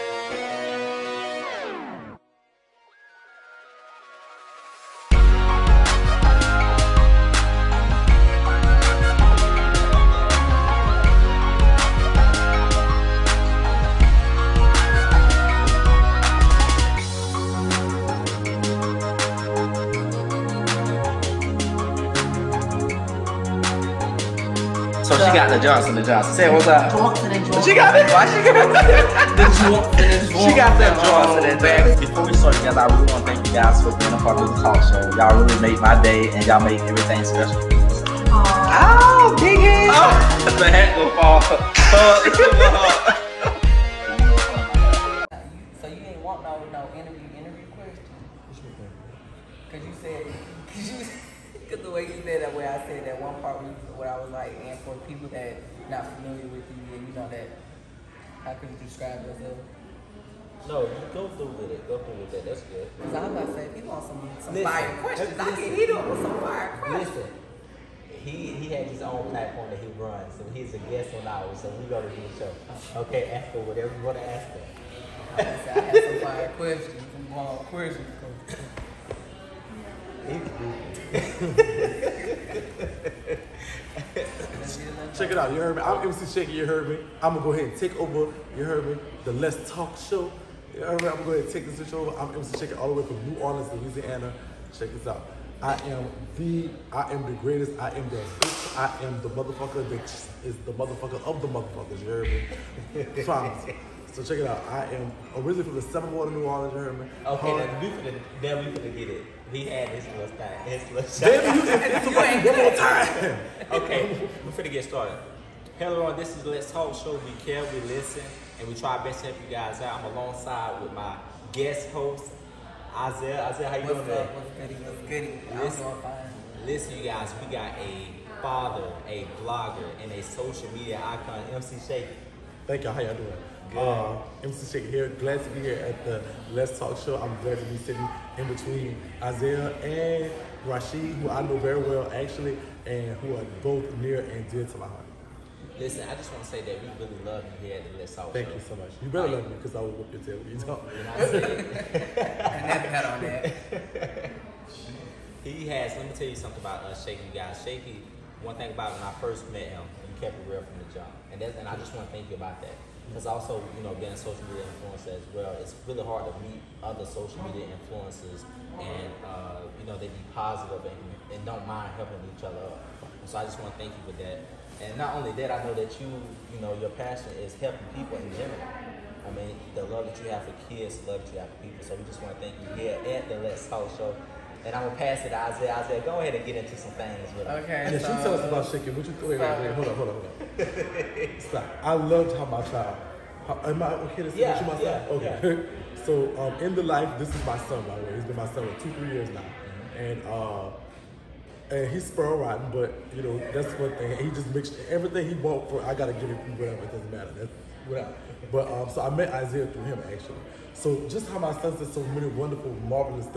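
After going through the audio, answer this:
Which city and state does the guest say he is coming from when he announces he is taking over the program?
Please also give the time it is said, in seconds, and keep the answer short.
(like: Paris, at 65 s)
New Orleans, Louisiana, at 93 s.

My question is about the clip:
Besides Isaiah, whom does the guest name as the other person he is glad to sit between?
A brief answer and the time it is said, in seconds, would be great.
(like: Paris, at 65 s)
Rashid, at 140 s.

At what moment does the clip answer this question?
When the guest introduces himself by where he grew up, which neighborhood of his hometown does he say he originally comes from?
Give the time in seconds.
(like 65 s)
105 s.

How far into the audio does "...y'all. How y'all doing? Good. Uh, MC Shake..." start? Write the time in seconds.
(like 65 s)
132 s.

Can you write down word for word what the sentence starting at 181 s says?
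So we just want to thank you here at the Let's Talk Show.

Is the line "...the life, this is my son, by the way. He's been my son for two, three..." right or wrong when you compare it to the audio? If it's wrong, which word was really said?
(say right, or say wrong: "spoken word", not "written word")
right.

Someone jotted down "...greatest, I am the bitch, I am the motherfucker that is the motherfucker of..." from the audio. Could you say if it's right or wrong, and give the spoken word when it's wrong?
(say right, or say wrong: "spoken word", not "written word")
right.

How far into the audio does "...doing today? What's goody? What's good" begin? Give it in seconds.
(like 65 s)
123 s.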